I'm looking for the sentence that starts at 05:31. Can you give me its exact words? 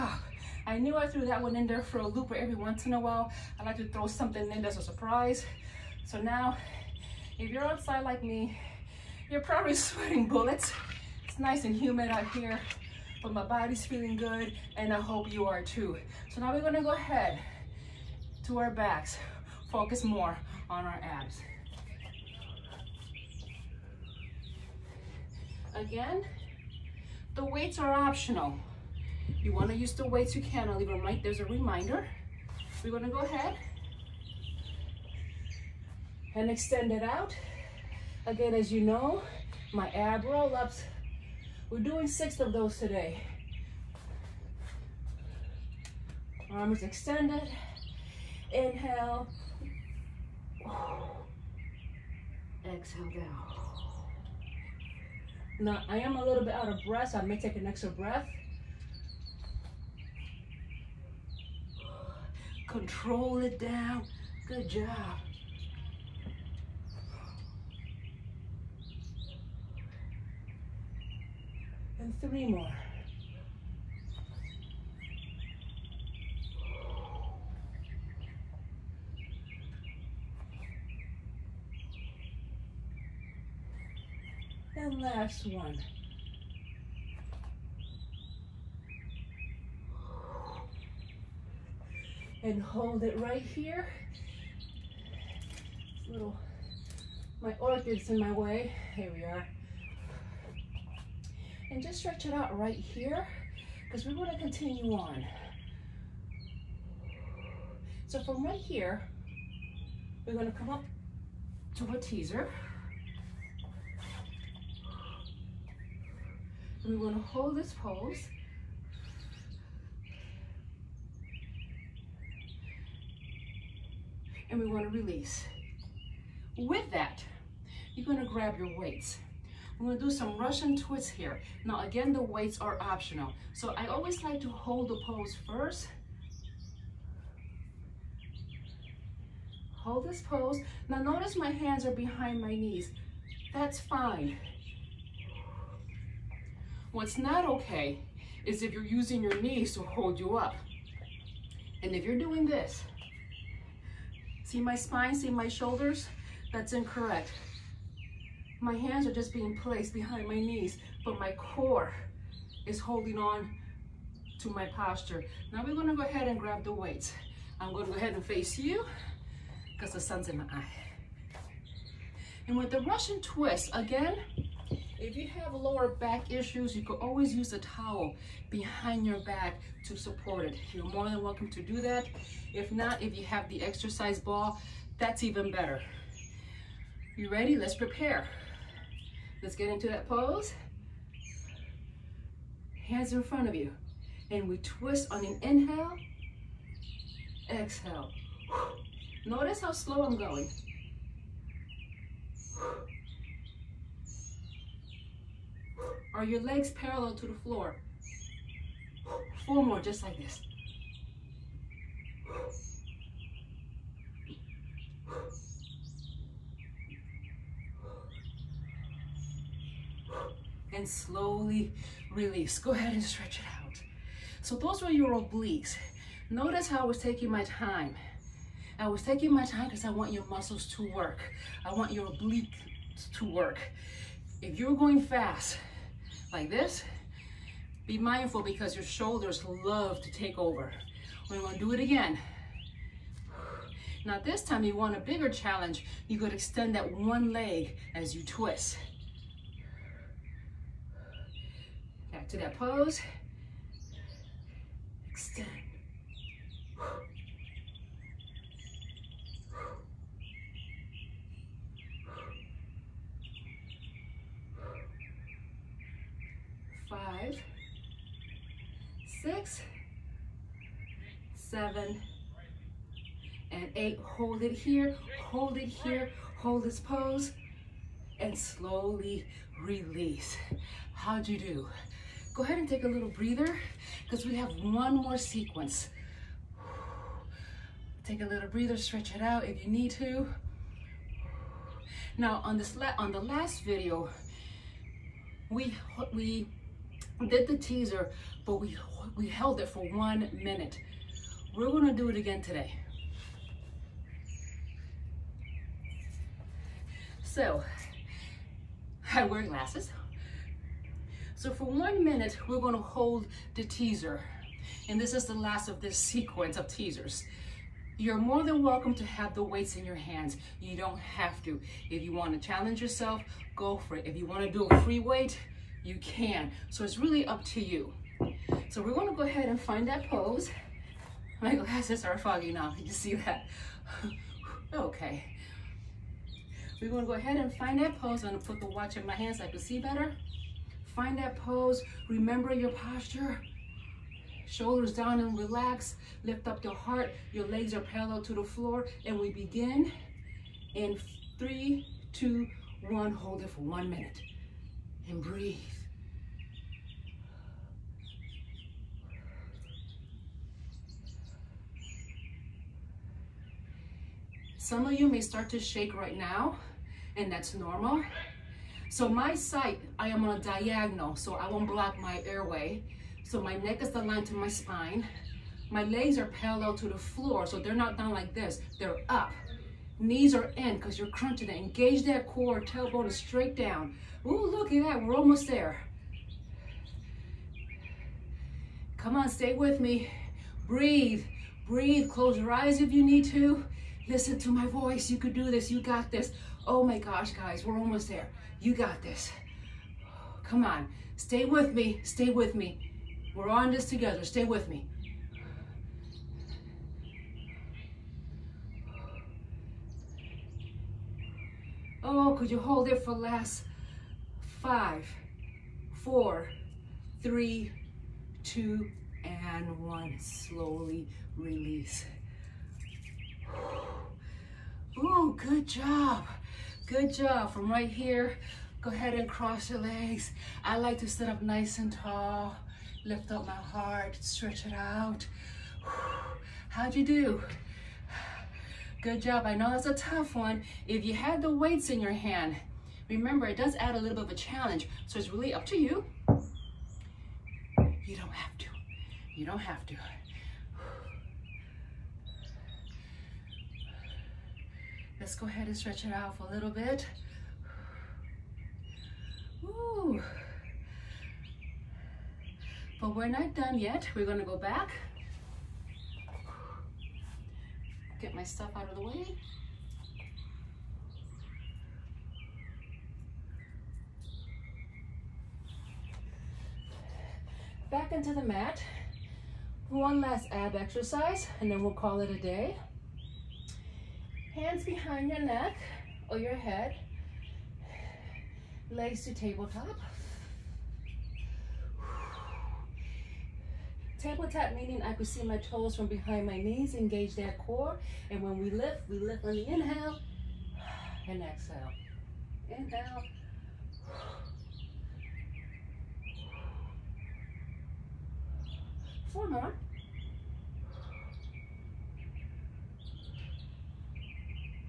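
My glasses are foggy now, you see that?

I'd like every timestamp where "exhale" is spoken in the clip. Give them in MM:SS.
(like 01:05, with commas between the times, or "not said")
00:52, 03:17, 08:21.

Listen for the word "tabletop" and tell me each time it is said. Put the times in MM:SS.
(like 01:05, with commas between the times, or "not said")
08:09, 08:14.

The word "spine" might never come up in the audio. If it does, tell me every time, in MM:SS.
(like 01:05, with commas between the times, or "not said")
02:34, 06:14.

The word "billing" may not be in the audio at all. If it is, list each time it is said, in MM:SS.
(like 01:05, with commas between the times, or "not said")
not said.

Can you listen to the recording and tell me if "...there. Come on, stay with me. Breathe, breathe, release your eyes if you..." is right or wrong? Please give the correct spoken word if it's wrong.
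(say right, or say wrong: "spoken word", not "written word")
wrong: "close", not "release".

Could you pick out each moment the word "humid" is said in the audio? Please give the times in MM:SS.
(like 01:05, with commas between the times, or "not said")
00:11.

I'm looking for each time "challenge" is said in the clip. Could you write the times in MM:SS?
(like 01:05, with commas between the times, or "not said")
04:05, 05:22, 07:24.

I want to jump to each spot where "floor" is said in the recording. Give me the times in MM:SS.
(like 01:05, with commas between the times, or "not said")
03:27, 05:48, 06:16.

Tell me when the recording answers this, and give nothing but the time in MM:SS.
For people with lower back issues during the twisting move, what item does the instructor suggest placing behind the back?
02:57.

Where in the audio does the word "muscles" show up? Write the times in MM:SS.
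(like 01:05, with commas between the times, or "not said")
03:50.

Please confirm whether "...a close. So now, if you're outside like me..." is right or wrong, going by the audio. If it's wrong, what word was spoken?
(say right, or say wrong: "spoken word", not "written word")
wrong: "surprise", not "close".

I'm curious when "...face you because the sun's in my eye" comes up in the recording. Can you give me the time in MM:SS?
02:48.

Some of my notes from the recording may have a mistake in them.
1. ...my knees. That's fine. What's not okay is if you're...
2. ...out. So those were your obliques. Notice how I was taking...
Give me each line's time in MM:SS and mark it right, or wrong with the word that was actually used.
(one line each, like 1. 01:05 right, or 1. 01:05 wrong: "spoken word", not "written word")
1. 02:22 right
2. 03:43 right.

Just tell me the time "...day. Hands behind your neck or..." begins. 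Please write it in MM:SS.
08:02.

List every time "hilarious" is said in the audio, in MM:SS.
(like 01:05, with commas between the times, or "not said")
not said.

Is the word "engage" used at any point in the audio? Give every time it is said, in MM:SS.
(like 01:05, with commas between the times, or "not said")
06:21, 08:16.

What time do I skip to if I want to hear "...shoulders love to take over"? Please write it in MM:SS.
03:58.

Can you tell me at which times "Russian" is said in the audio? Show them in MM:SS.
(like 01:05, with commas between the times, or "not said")
02:10, 02:52.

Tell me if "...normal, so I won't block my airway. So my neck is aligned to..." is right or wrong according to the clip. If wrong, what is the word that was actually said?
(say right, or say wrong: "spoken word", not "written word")
wrong: "diagonal", not "normal".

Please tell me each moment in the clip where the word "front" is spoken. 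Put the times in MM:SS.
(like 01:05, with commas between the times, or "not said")
03:13.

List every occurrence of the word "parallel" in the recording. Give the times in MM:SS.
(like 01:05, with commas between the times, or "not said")
03:26, 05:47, 06:16.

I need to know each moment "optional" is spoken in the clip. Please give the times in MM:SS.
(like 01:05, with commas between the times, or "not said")
00:27, 02:12.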